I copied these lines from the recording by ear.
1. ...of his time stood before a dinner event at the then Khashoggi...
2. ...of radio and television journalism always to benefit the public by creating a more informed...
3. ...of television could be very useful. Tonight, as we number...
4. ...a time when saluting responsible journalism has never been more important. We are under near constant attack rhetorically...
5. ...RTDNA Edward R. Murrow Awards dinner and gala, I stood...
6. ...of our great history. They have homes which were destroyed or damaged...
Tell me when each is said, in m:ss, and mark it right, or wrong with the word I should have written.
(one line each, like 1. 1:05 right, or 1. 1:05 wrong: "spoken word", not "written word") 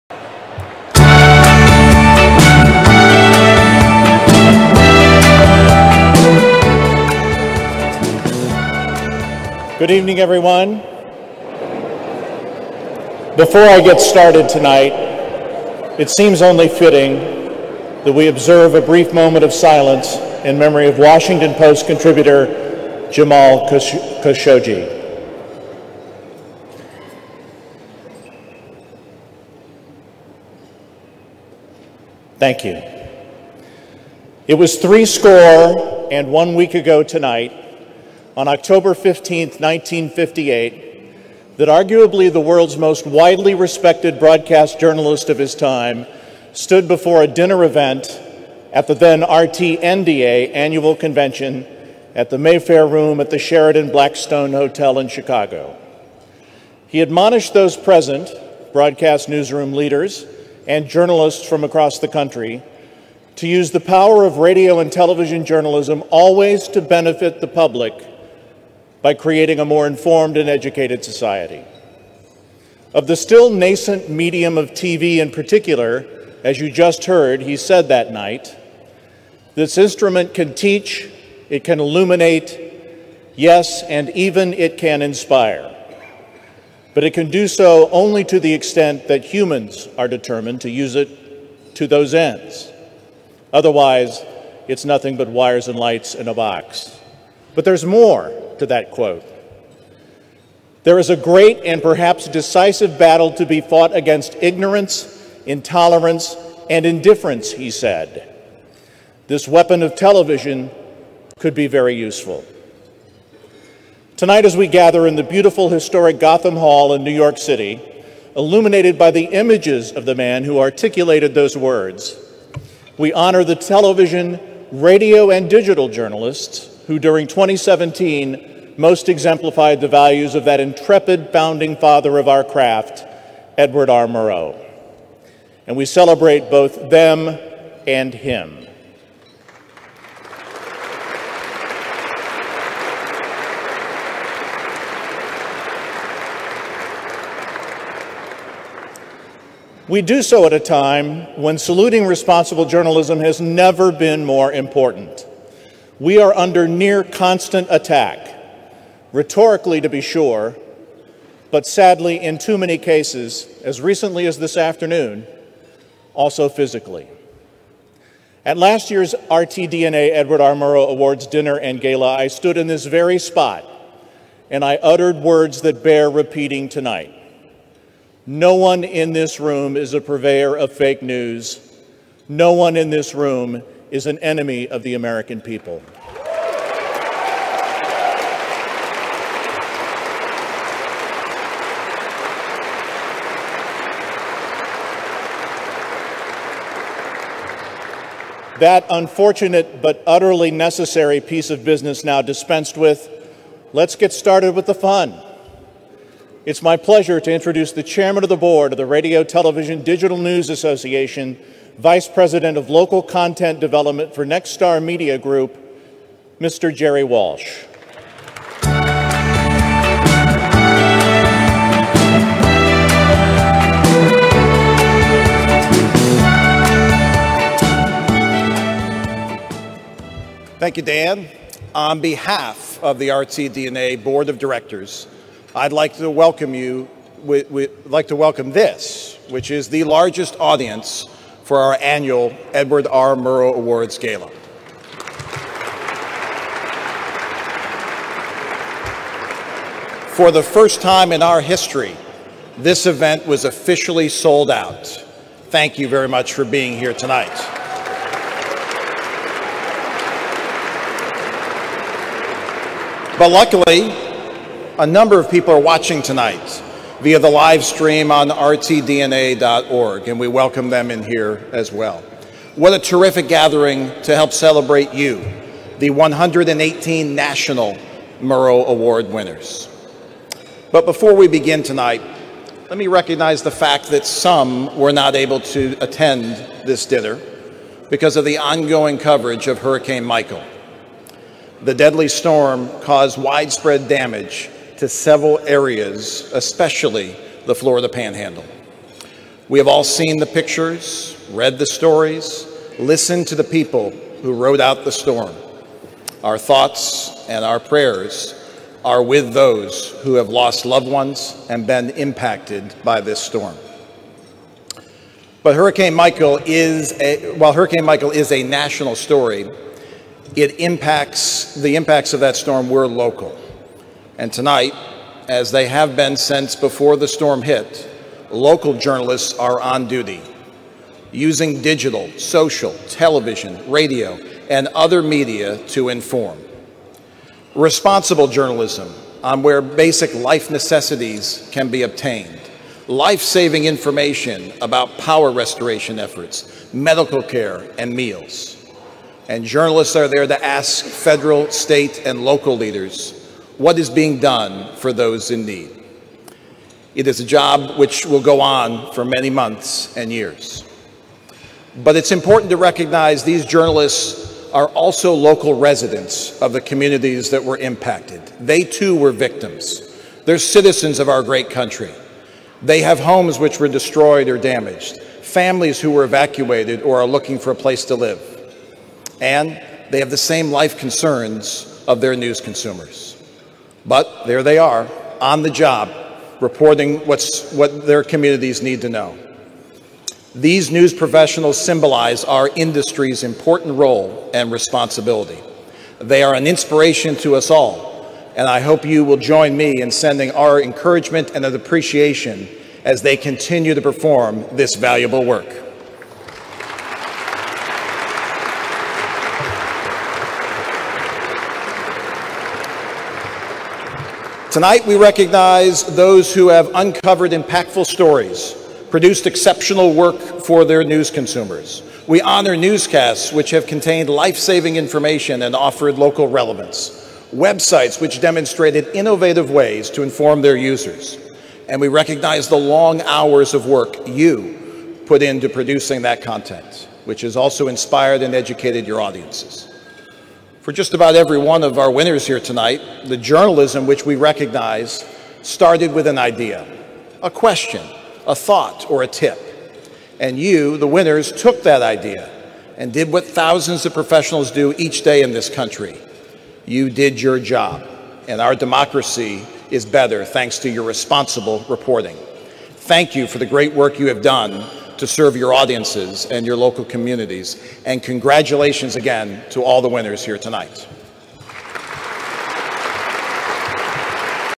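1. 0:45 wrong: "RTNDA", not "Khashoggi"
2. 1:04 right
3. 1:49 wrong: "gather", not "number"
4. 2:30 right
5. 2:49 right
6. 6:10 wrong: "country", not "history".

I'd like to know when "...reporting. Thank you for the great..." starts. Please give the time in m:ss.
7:41.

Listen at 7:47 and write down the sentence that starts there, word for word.
And congratulations again to all the winners here tonight.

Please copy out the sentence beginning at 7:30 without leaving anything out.
And you, the winners, took that idea and did what thousands of professionals do each day in this country.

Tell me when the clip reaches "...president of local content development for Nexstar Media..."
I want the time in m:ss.
3:32.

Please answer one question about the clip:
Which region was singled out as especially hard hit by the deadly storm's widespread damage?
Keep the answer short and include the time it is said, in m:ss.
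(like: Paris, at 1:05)
Florida Panhandle, at 4:57.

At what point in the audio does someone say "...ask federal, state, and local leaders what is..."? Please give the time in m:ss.
5:50.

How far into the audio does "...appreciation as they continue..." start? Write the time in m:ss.
6:41.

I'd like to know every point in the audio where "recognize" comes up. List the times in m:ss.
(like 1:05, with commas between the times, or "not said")
4:42, 6:02, 6:54, 7:11, 7:24.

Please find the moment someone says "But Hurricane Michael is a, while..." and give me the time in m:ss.
5:15.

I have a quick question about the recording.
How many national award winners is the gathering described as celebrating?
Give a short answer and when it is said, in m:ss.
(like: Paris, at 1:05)
118, at 4:35.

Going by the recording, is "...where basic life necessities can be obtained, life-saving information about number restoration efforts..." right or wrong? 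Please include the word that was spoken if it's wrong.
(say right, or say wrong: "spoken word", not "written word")
wrong: "power", not "number".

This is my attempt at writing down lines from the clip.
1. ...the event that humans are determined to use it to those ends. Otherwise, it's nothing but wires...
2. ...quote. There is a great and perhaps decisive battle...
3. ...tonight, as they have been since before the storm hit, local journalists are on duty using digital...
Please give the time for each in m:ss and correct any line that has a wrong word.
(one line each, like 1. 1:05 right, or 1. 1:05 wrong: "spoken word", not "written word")
1. 1:28 wrong: "extent", not "event"
2. 1:38 right
3. 5:24 right.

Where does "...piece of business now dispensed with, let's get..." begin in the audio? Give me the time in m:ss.
3:21.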